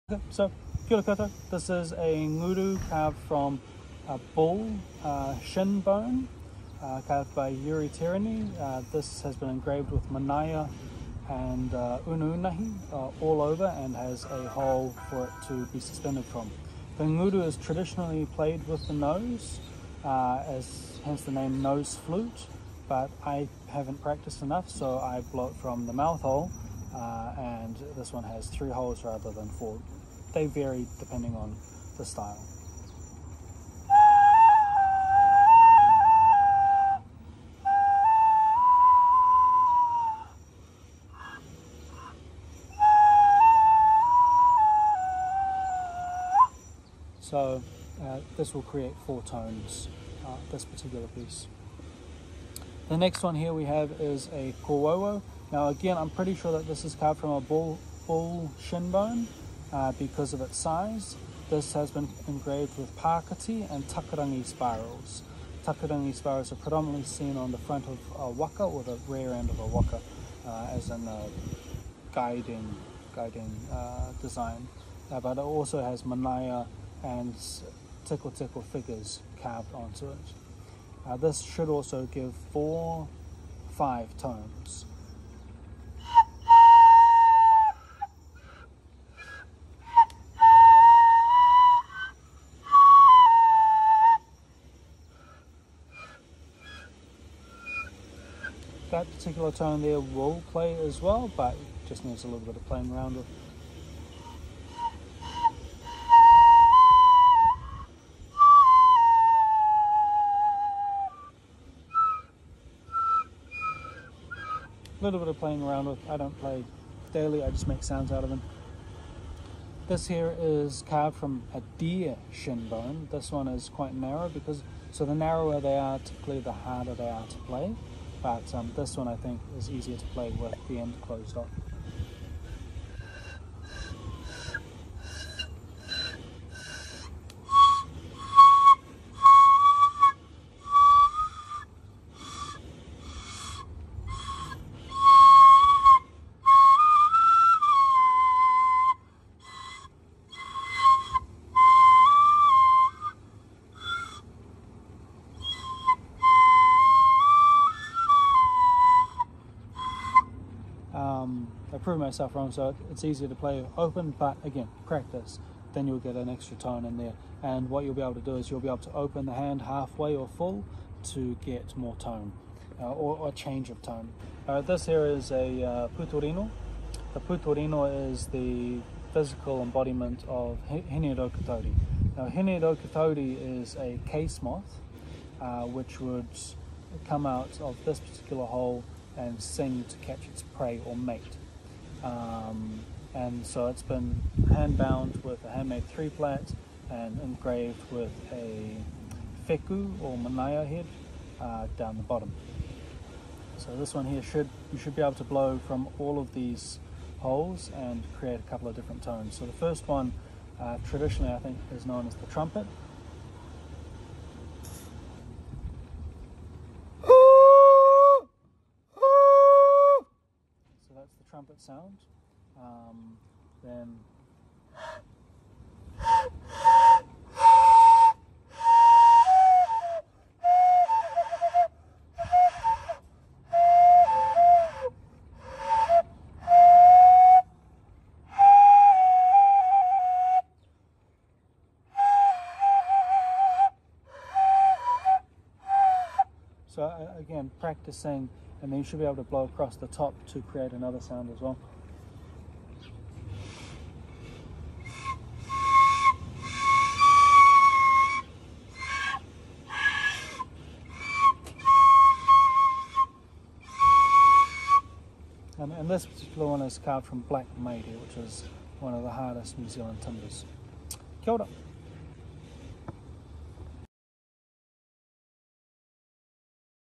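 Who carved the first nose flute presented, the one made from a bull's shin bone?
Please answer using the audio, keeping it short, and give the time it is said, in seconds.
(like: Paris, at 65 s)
Yuri Terani, at 7 s.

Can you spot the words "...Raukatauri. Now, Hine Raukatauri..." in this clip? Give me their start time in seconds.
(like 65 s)
181 s.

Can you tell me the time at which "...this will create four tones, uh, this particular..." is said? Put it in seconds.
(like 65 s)
48 s.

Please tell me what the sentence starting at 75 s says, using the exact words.
Uh, but it also has manaia and tickle tickle figures carved onto it.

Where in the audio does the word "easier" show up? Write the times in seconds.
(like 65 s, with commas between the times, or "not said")
129 s, 163 s.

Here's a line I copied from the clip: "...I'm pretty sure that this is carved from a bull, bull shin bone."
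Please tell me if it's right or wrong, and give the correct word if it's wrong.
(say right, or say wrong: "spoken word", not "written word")
right.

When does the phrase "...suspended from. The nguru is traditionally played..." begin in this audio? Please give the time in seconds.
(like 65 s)
15 s.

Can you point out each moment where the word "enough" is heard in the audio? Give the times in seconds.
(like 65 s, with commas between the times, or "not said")
24 s.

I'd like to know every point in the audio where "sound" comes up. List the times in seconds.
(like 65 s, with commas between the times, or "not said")
117 s, 221 s, 250 s.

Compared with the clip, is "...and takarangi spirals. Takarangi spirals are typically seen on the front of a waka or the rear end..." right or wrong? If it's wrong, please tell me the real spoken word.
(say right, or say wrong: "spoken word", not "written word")
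wrong: "predominantly", not "typically".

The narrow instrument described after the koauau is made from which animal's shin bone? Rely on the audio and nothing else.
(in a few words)
deer.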